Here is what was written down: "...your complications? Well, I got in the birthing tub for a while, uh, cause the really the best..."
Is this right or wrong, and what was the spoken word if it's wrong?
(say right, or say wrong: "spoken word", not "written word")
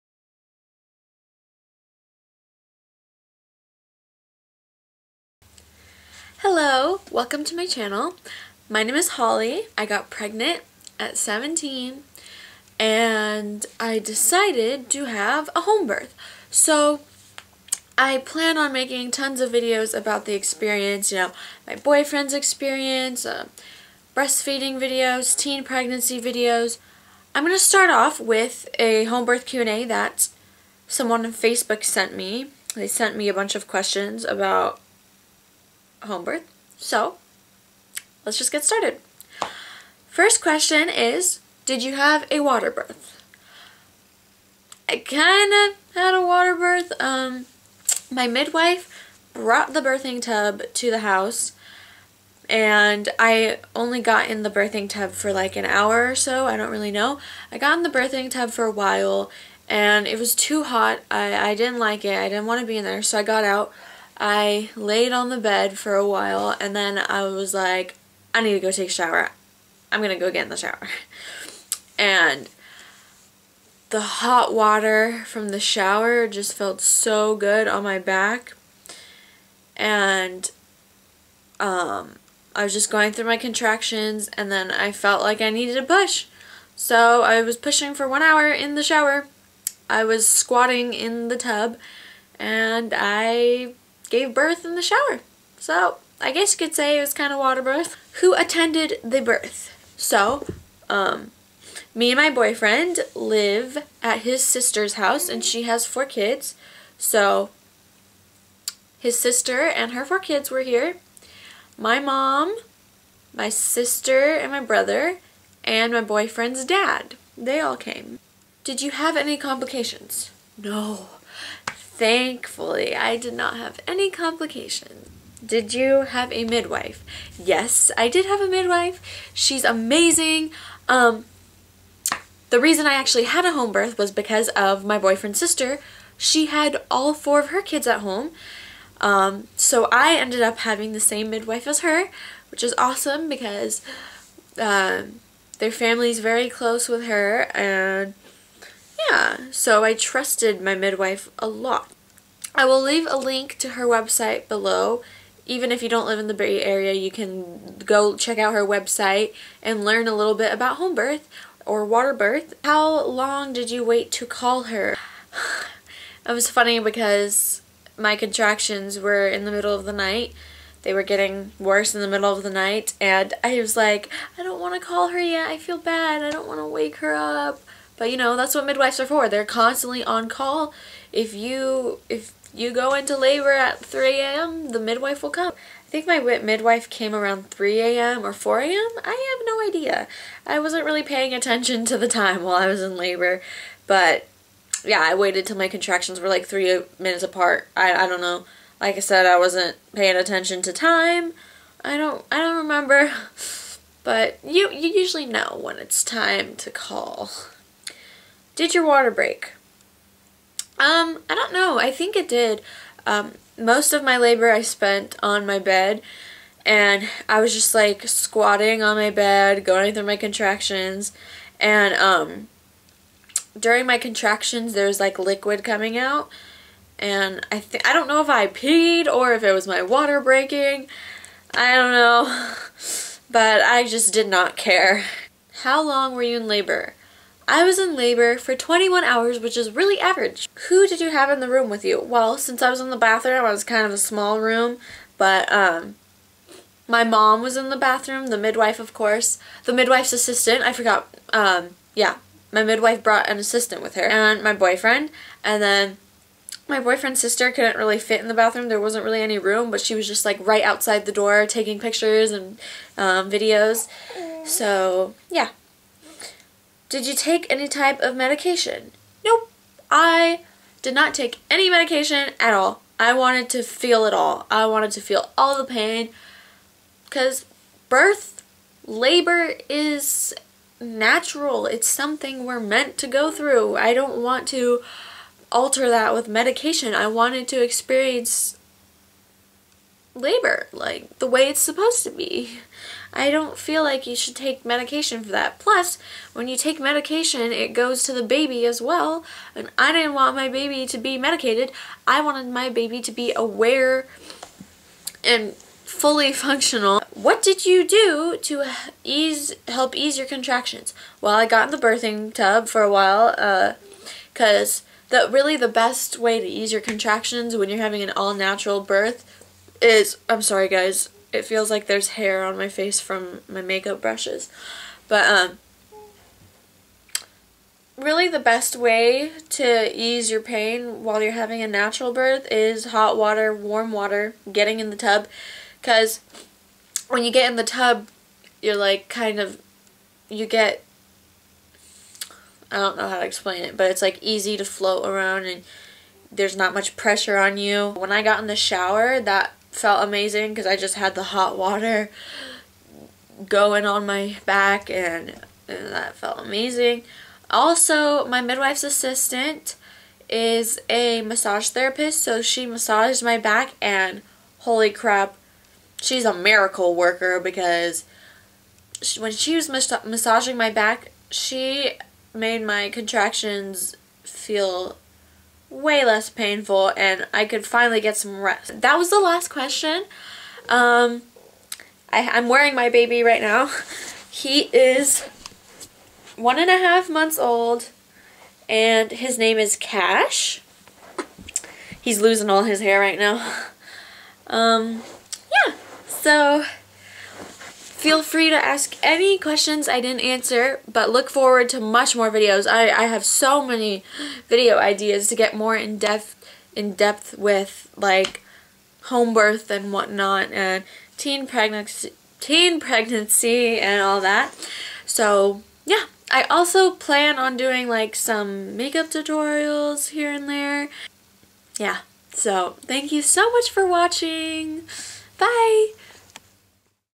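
wrong: "contractions", not "complications".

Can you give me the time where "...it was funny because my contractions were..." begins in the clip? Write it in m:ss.
2:46.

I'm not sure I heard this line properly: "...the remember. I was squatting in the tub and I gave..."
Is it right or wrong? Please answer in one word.
wrong.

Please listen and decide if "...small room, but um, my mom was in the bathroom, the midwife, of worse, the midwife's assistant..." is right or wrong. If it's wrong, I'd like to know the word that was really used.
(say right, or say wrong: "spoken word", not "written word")
wrong: "course", not "worse".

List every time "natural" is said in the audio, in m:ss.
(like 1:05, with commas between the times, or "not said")
4:40, 5:18, 5:31.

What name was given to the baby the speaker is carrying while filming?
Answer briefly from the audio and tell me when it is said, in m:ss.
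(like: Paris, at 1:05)
Cash, at 6:29.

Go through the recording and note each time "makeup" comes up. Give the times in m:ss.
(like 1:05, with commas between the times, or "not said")
5:23, 6:58.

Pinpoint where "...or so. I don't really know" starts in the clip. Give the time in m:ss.
0:56.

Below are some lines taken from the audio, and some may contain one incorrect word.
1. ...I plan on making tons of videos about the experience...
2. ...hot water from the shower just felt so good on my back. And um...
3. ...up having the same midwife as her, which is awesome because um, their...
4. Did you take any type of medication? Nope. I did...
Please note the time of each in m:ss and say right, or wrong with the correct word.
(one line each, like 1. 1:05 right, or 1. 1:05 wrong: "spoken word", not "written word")
1. 0:17 right
2. 1:14 right
3. 2:20 right
4. 4:26 right.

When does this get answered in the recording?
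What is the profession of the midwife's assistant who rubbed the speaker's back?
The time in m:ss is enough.
6:01.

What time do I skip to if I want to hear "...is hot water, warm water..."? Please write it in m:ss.
5:32.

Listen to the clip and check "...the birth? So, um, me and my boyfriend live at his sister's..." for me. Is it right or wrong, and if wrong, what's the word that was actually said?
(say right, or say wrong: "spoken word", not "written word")
right.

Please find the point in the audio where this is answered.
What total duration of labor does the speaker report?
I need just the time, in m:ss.
3:58.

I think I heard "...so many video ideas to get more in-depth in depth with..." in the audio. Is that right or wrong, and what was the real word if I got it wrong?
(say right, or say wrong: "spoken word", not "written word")
right.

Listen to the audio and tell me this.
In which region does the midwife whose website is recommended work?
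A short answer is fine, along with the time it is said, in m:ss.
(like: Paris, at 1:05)
Bay Area, at 2:36.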